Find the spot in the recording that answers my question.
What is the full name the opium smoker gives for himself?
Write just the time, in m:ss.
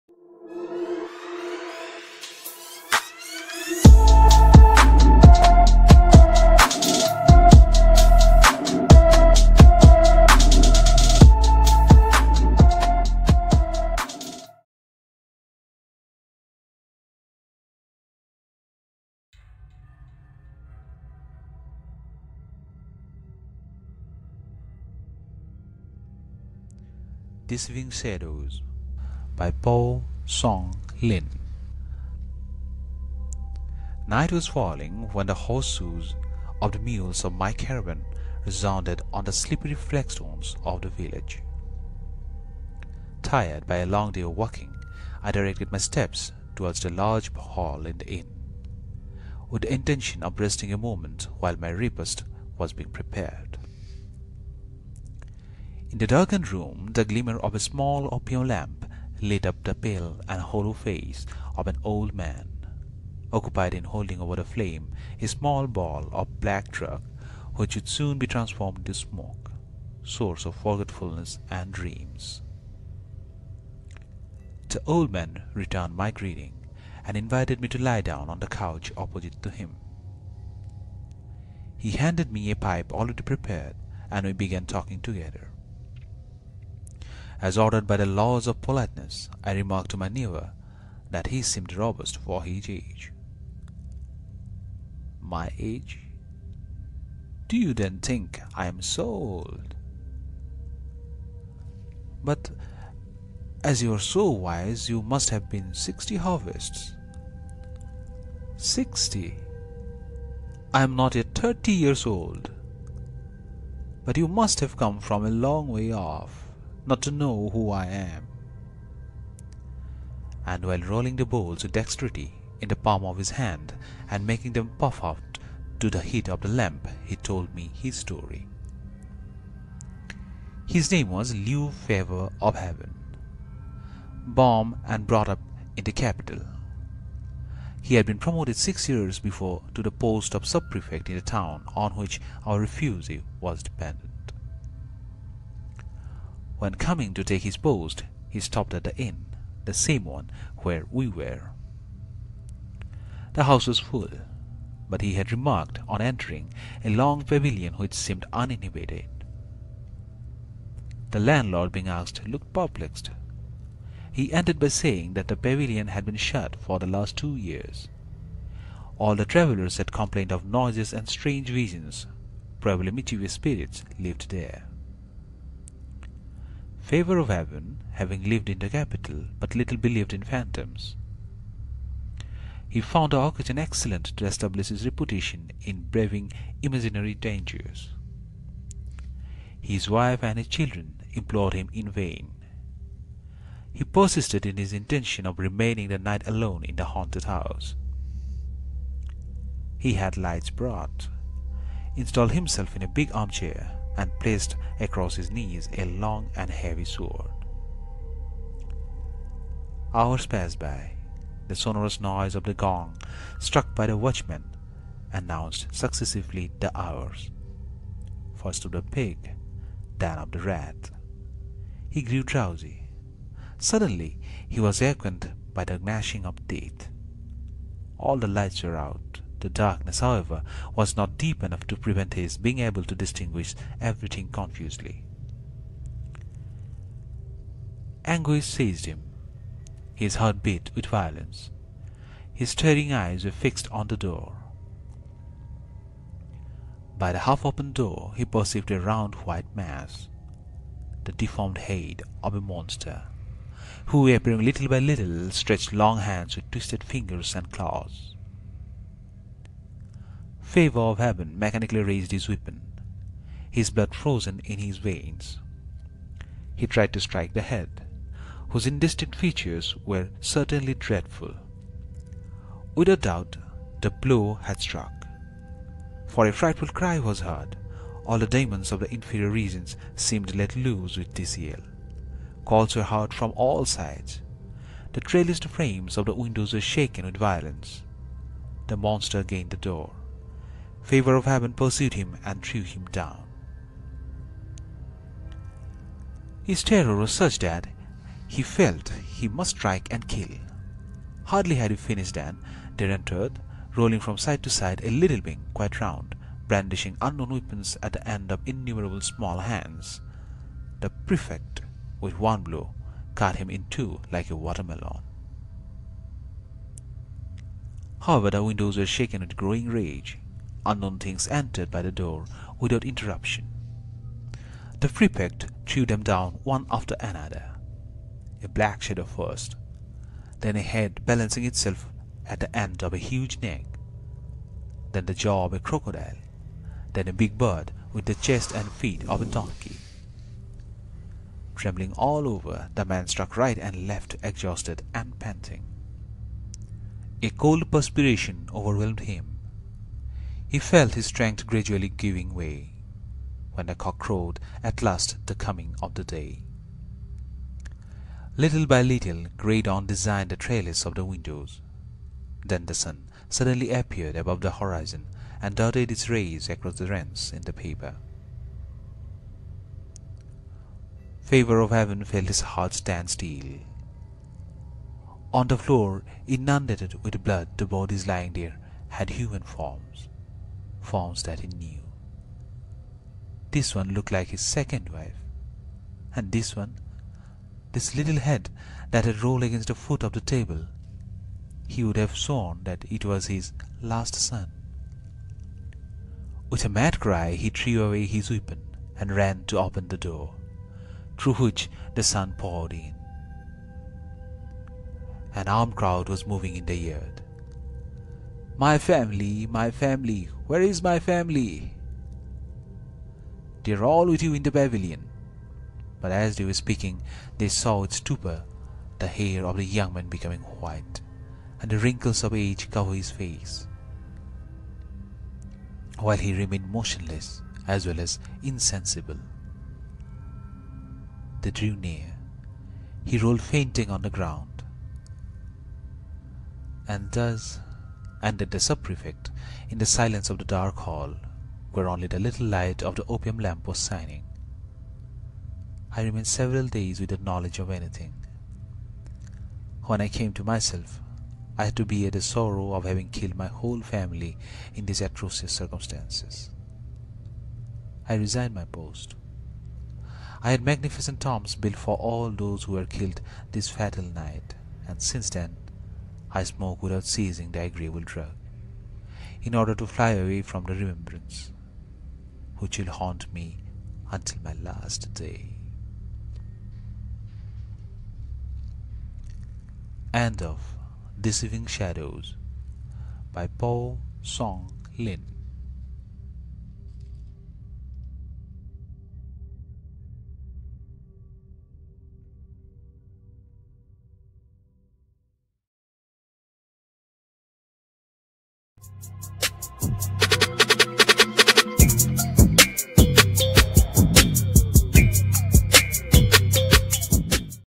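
2:11.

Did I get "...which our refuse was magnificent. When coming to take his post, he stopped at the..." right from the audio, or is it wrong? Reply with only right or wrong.
wrong.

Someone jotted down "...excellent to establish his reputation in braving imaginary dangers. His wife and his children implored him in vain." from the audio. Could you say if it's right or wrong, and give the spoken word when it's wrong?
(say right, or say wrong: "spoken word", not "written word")
right.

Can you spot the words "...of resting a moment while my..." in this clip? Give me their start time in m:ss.
0:50.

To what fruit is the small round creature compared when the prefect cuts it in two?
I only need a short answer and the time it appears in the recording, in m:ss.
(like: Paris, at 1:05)
Watermelon, at 5:14.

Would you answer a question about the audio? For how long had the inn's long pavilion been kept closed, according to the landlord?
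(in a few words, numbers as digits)
2 years.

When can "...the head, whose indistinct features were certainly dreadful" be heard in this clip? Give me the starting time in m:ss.
4:27.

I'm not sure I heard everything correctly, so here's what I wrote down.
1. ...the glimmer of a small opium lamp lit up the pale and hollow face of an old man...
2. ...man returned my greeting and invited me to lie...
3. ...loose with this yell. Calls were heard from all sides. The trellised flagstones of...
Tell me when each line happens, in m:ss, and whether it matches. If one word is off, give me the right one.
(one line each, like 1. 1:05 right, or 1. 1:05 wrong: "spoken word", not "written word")
1. 0:56 right
2. 1:15 right
3. 4:40 wrong: "frames", not "flagstones".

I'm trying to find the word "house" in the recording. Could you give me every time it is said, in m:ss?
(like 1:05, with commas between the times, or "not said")
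2:33, 3:17.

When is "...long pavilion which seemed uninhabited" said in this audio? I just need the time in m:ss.
2:36.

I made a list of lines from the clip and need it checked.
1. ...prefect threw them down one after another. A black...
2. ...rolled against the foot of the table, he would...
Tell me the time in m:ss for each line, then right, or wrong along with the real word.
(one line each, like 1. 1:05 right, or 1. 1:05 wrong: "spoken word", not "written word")
1. 5:24 right
2. 6:29 right.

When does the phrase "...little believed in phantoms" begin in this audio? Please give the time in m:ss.
2:59.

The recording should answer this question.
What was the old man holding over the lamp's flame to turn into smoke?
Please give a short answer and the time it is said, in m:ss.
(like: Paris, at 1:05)
A small ball of black drug, at 1:05.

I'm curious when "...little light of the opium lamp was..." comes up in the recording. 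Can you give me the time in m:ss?
7:22.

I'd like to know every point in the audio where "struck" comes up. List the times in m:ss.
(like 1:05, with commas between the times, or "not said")
3:33, 4:34, 5:43.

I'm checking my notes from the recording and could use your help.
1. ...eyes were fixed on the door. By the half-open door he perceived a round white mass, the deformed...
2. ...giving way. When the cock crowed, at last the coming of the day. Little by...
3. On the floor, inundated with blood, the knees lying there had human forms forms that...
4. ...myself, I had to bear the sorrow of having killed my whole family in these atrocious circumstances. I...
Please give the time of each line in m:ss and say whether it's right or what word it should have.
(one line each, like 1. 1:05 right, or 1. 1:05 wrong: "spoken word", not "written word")
1. 4:02 right
2. 5:51 right
3. 6:15 wrong: "bodies", not "knees"
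4. 7:30 right.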